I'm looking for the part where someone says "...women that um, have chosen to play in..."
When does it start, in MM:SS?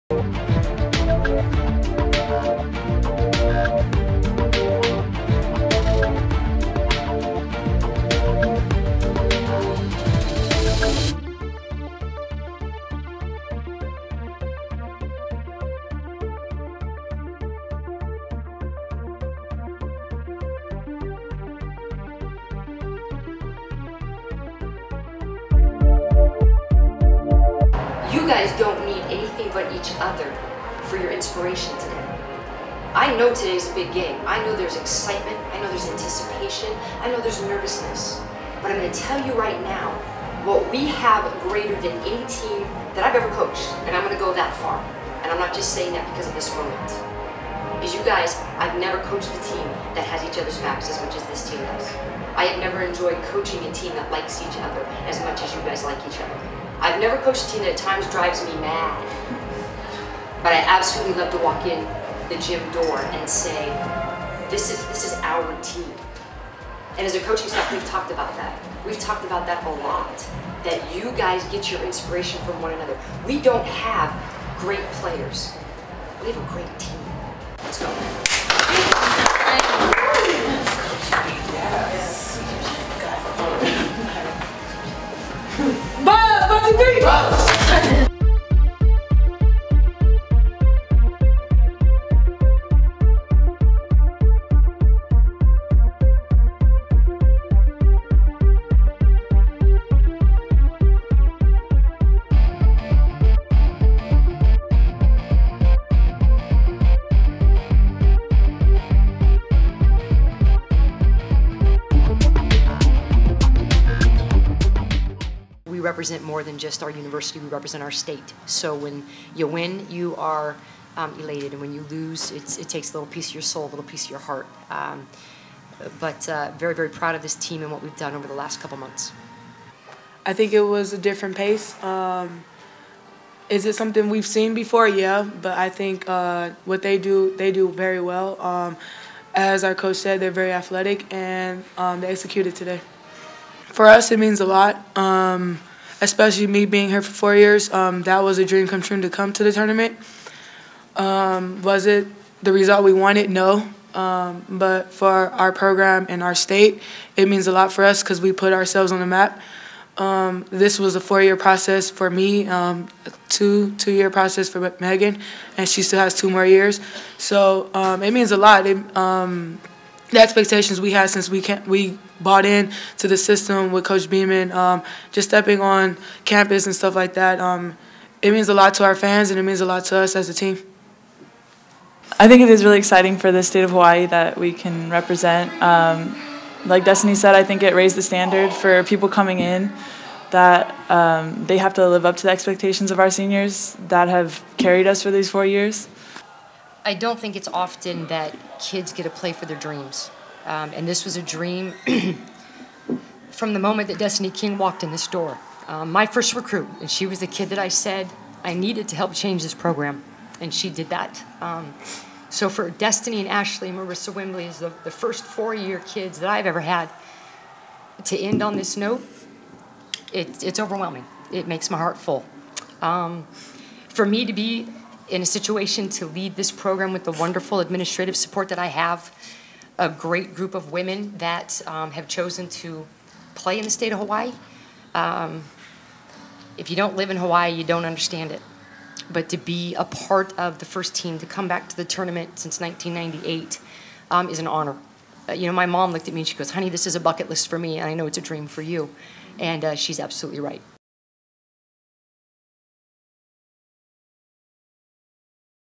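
03:50.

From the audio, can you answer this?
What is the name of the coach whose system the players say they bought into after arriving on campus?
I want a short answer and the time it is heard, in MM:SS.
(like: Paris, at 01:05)
Coach Beeman, at 02:53.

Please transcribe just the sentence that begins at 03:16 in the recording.
I don't think it's often that kids get to play for their dreams.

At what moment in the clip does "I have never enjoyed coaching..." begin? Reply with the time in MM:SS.
00:52.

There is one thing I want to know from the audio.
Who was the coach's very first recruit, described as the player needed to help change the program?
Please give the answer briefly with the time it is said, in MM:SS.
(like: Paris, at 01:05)
Destiny King, at 03:23.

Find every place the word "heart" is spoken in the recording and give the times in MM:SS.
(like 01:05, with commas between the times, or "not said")
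02:04, 03:41.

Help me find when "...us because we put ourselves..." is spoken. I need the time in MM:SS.
02:37.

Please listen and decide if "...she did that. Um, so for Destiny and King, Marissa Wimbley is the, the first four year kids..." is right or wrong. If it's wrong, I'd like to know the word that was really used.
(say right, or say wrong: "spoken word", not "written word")
wrong: "Ashley", not "King".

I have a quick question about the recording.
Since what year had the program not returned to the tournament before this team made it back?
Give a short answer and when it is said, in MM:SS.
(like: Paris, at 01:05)
1998, at 04:02.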